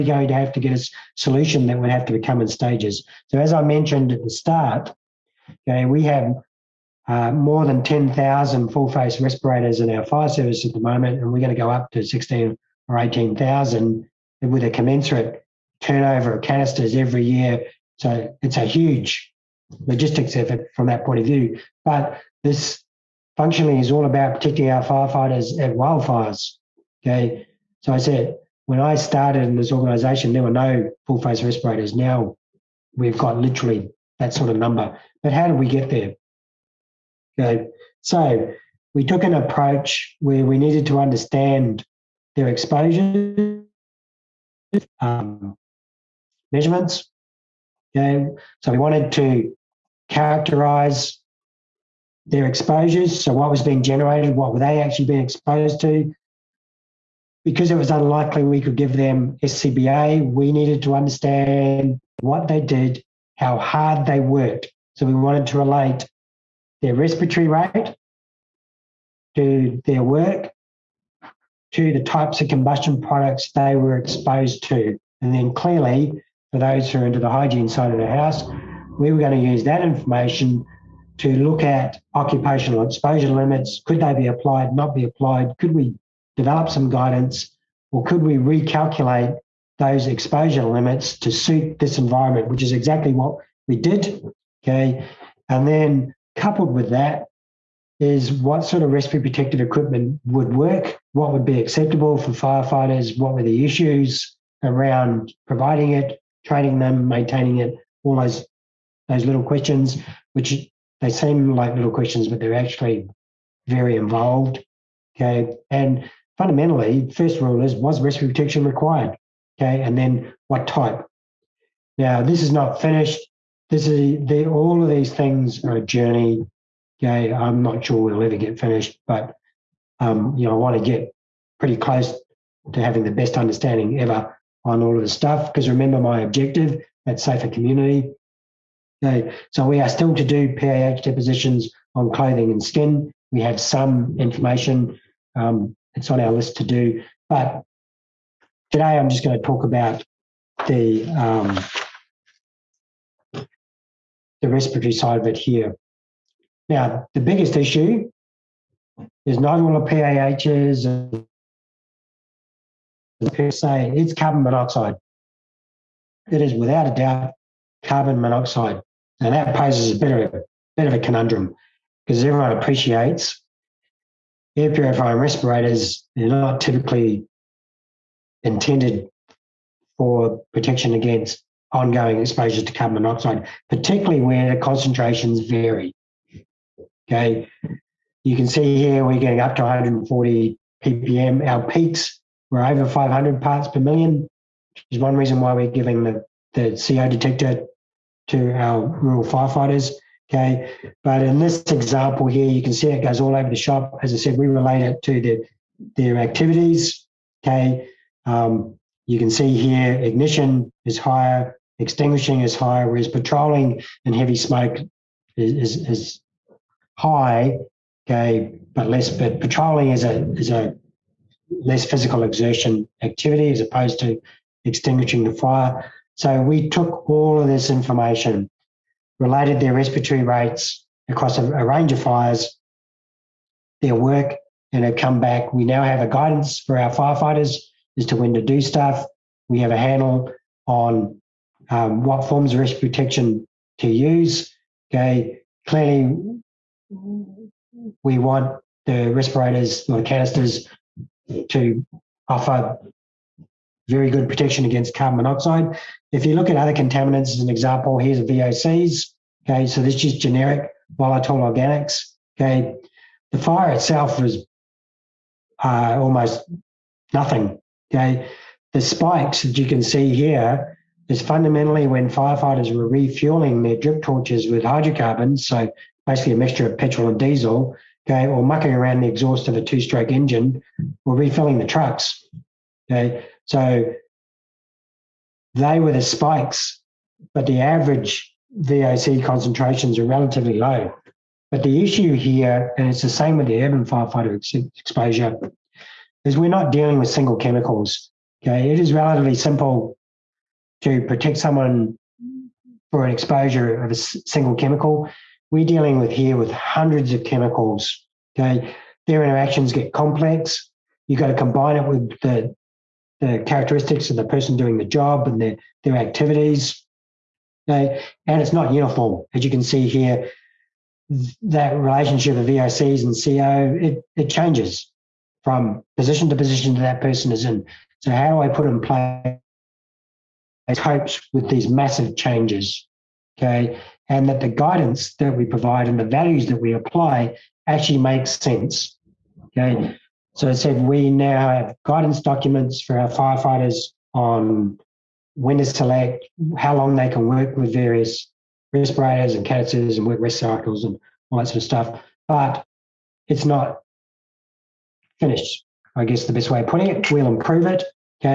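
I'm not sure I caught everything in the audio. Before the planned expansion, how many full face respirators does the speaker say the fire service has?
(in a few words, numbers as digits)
more than 10,000.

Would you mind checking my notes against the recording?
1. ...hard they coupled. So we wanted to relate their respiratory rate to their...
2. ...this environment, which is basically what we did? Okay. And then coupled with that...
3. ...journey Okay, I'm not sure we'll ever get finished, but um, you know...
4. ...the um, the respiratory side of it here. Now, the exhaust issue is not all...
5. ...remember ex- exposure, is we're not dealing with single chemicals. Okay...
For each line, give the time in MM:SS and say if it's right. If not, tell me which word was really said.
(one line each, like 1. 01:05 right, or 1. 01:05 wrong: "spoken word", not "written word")
1. 01:03 wrong: "worked", not "coupled"
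2. 01:31 wrong: "exactly", not "basically"
3. 02:05 right
4. 02:30 wrong: "biggest", not "exhaust"
5. 04:53 wrong: "firefighter", not "remember".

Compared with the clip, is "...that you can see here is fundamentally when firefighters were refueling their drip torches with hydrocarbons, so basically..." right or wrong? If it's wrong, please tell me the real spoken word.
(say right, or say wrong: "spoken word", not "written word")
right.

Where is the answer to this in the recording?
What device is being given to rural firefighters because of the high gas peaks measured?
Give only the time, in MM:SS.
03:16.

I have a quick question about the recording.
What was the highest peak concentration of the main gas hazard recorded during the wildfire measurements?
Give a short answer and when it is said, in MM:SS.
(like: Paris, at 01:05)
over 500 ppm, at 03:12.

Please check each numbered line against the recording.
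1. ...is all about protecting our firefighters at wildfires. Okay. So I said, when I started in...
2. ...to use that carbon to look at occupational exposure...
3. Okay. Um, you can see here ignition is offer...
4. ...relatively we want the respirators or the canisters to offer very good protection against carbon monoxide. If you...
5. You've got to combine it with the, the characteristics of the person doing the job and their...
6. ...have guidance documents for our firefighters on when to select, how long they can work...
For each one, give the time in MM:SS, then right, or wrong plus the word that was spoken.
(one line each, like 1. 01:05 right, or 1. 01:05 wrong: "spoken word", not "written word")
1. 00:23 right
2. 01:19 wrong: "information", not "carbon"
3. 03:27 wrong: "higher", not "offer"
4. 04:05 wrong: "clearly", not "relatively"
5. 05:11 right
6. 05:41 right.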